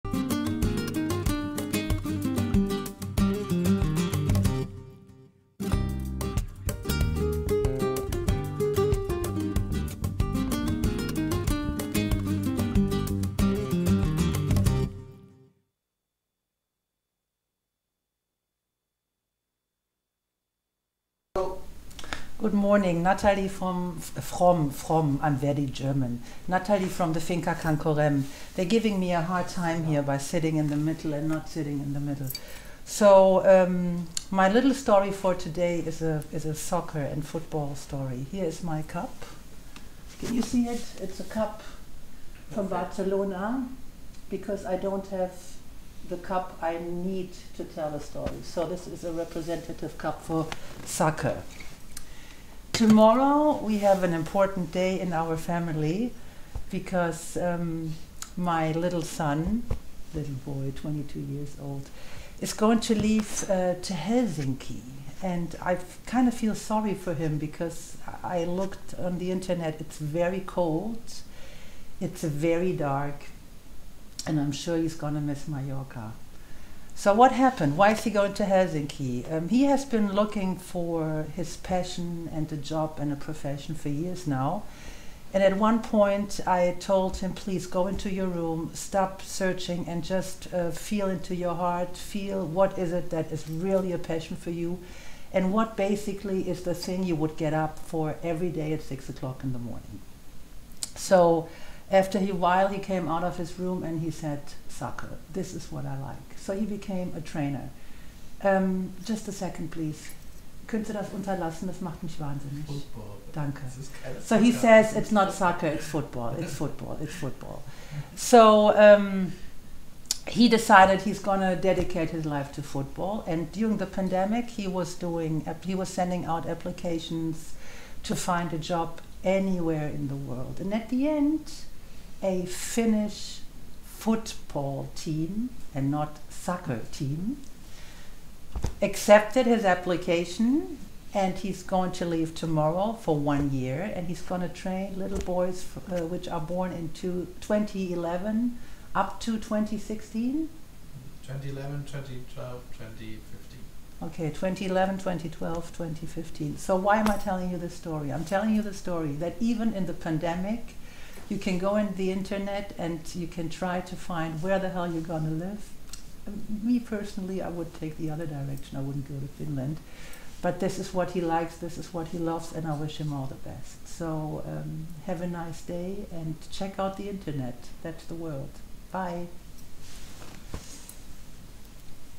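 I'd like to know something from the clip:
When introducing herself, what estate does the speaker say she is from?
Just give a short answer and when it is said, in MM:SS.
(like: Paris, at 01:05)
Finca Can Corem, at 00:27.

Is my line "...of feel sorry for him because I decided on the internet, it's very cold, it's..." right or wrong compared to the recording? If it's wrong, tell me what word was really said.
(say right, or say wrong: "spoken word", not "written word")
wrong: "looked", not "decided".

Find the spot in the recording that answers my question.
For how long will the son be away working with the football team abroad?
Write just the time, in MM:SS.
02:23.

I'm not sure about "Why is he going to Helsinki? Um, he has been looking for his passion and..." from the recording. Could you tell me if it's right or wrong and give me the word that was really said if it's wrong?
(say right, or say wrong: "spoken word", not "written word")
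right.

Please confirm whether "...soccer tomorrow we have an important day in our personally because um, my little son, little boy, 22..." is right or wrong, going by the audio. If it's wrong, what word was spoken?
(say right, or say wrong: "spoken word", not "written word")
wrong: "family", not "personally".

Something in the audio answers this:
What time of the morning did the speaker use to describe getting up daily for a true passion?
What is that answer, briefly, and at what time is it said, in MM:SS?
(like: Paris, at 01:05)
6 o'clock, at 01:38.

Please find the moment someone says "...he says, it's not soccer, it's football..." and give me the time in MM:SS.
01:54.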